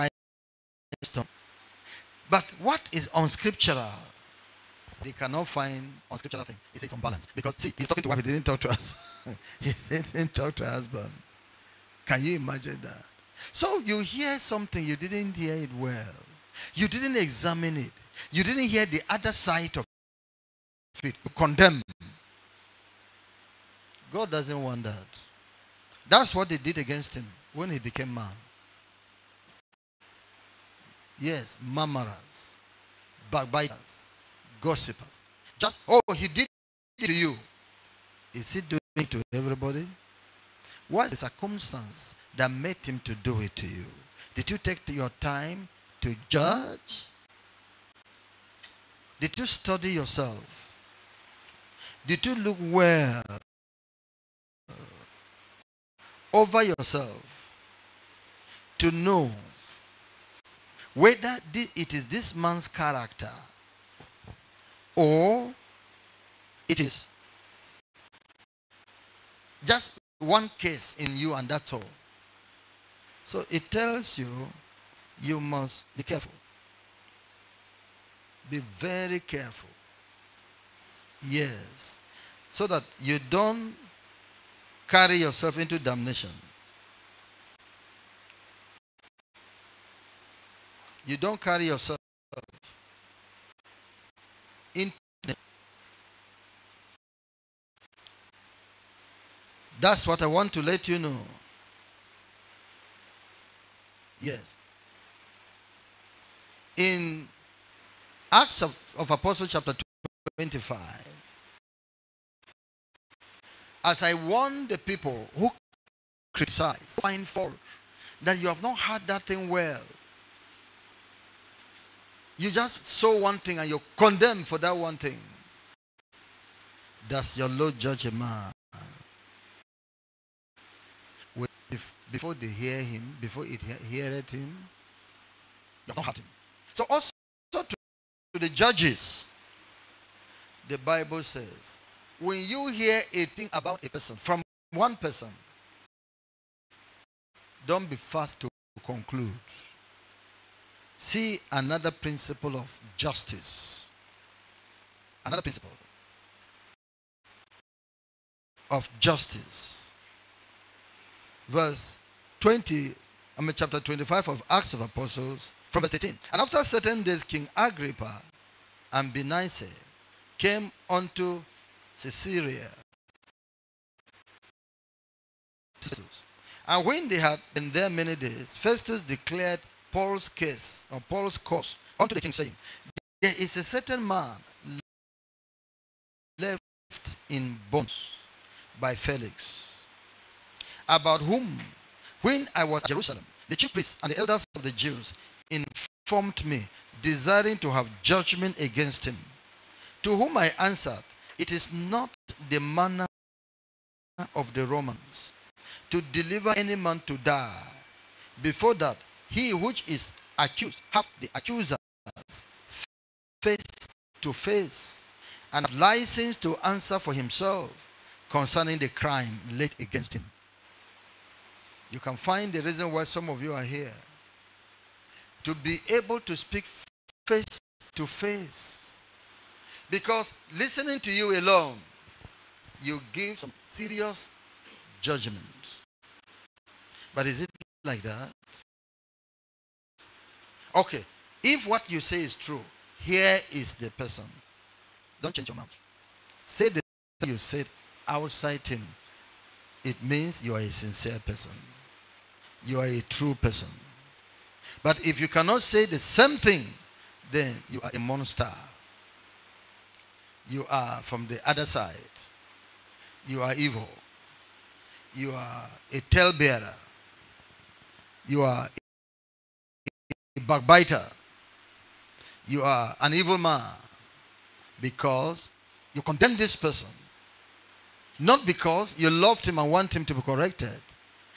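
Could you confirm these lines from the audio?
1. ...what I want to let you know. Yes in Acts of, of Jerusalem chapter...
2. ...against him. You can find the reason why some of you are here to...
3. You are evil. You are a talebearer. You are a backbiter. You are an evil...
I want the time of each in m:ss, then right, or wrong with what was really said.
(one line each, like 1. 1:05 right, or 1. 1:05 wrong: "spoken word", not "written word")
1. 1:40 wrong: "Apostles", not "Jerusalem"
2. 3:39 right
3. 4:23 right.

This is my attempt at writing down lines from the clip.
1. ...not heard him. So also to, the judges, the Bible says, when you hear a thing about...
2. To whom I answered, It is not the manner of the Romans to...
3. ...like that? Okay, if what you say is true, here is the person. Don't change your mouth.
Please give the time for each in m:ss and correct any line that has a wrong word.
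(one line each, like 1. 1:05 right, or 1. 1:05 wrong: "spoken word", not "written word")
1. 2:15 right
2. 3:20 right
3. 3:57 right.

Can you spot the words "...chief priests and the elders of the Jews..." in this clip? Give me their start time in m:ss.
3:13.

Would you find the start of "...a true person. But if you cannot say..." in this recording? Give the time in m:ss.
4:12.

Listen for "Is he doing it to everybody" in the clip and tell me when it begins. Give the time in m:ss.
0:38.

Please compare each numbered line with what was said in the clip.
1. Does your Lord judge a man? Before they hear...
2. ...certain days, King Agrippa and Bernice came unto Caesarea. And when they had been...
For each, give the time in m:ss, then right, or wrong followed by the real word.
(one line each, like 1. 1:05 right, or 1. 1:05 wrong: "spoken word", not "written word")
1. 2:07 right
2. 2:46 right.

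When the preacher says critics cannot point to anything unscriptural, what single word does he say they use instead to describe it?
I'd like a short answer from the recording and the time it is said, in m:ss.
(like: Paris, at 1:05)
Unbalanced, at 0:06.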